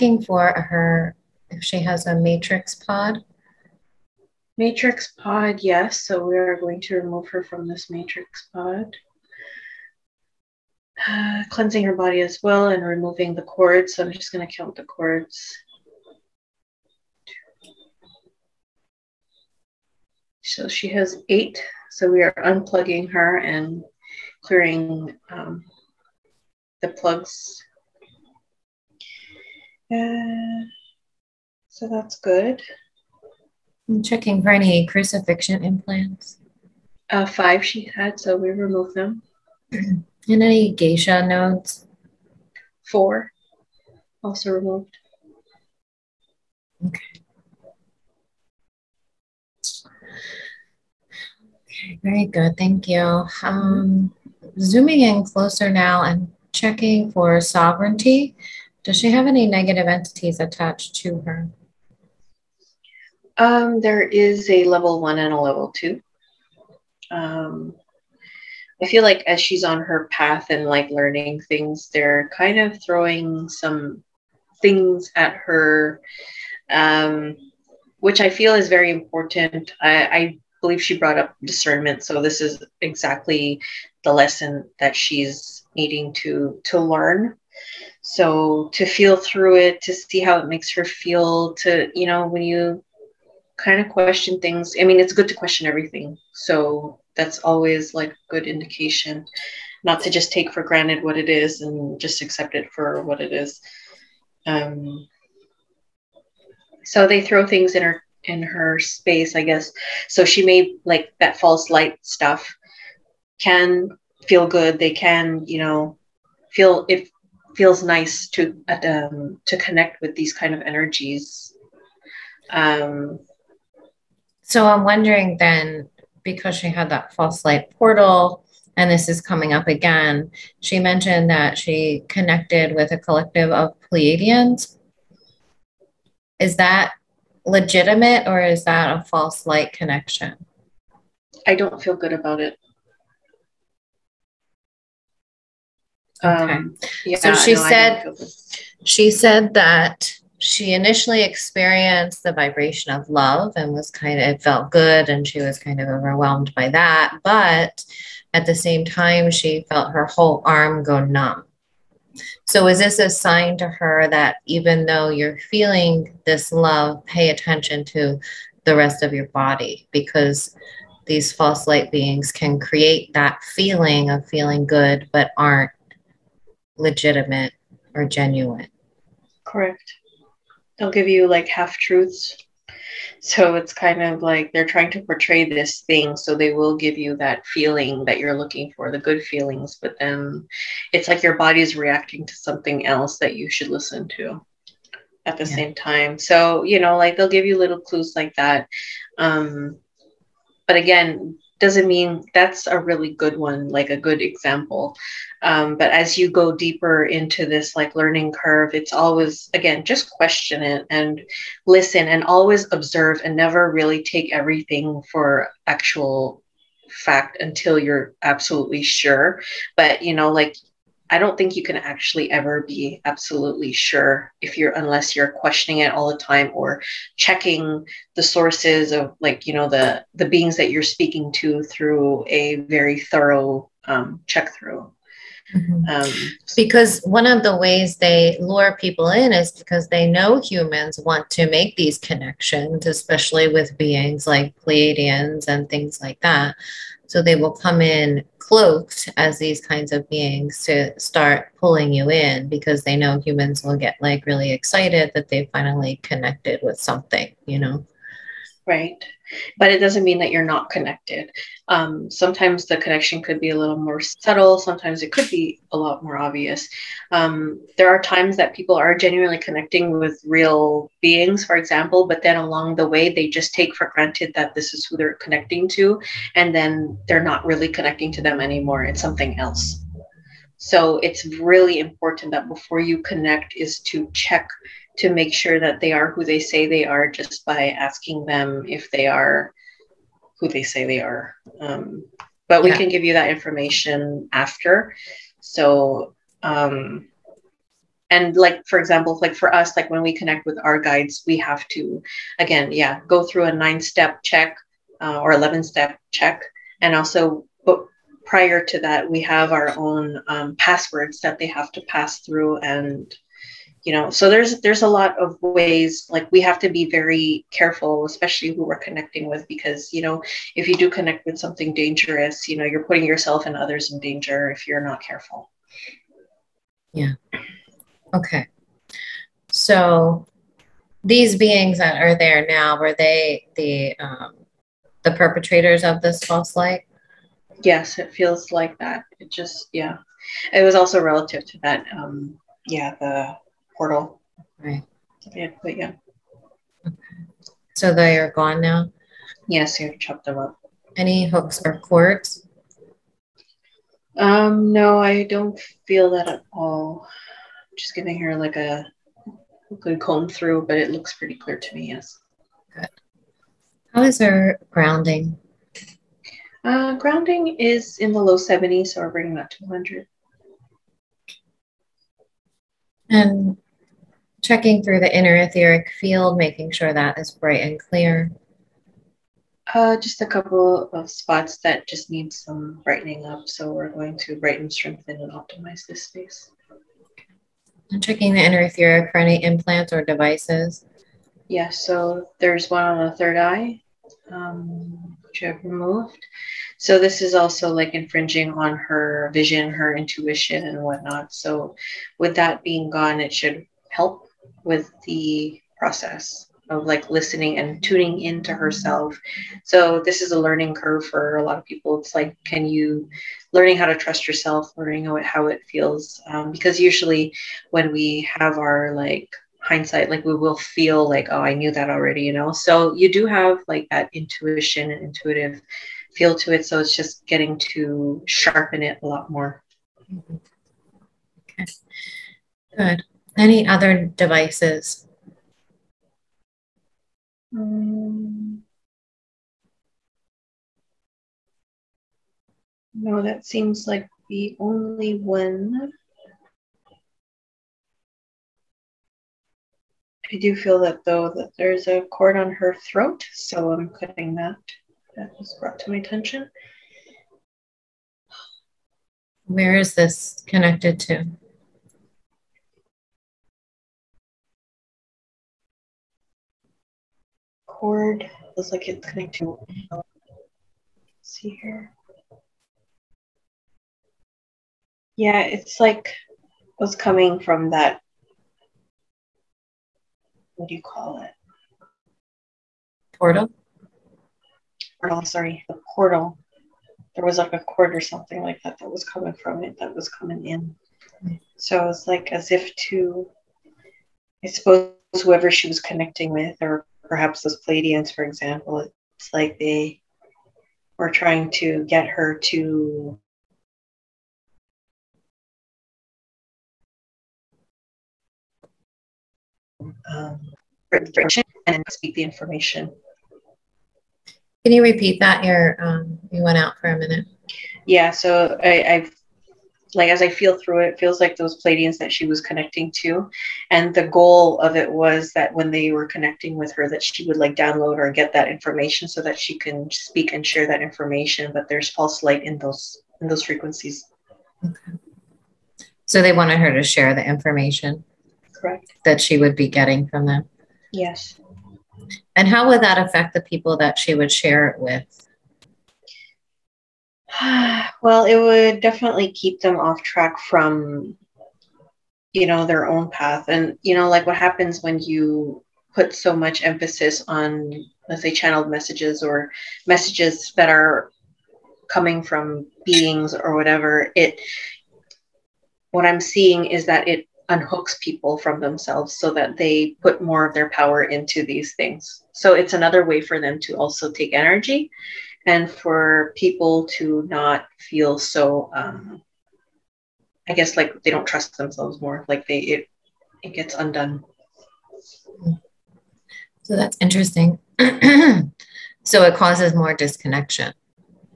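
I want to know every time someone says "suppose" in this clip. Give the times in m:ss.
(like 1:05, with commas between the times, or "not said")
8:14.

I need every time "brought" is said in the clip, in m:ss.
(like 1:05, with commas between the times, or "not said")
1:20, 7:35.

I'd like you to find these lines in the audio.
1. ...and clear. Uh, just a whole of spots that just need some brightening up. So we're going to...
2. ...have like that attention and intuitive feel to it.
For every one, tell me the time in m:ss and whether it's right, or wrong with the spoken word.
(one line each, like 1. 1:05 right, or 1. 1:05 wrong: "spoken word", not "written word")
1. 6:17 wrong: "couple", not "whole"
2. 7:03 wrong: "intuition", not "attention".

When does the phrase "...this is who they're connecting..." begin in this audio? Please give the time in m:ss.
4:34.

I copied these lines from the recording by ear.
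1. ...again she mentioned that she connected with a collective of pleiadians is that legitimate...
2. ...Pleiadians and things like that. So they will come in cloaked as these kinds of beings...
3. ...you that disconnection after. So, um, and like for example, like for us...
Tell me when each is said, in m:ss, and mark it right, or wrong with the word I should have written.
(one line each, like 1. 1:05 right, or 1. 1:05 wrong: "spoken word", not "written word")
1. 2:09 right
2. 4:04 right
3. 4:53 wrong: "information", not "disconnection".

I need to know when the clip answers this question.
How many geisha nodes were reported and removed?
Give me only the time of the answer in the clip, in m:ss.
0:42.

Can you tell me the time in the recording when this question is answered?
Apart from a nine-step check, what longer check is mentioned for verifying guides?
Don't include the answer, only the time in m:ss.
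5:05.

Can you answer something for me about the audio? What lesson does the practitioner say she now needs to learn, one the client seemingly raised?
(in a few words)
Discernment.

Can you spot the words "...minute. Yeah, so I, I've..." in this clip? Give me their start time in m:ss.
8:36.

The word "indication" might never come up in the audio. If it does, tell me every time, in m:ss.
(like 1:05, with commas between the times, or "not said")
1:38.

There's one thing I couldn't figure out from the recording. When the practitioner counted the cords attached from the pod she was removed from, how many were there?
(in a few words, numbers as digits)
8.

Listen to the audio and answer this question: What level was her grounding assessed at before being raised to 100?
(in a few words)
Low 70s.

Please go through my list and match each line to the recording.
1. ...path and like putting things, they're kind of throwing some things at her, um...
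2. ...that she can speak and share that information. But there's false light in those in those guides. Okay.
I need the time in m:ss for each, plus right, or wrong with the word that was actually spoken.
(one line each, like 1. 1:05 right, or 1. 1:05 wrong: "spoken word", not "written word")
1. 1:10 wrong: "learning", not "putting"
2. 8:49 wrong: "frequencies", not "guides".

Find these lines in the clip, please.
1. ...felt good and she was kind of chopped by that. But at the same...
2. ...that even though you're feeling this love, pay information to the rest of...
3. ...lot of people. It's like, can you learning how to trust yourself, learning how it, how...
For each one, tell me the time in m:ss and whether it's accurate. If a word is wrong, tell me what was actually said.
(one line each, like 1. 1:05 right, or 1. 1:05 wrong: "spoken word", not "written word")
1. 2:34 wrong: "overwhelmed", not "chopped"
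2. 2:44 wrong: "attention", not "information"
3. 6:51 right.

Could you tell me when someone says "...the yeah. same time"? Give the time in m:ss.
3:15.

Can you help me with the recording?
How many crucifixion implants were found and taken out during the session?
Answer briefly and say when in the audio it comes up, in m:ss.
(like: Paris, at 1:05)
5, at 0:37.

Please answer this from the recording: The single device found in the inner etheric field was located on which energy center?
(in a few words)
Third eye.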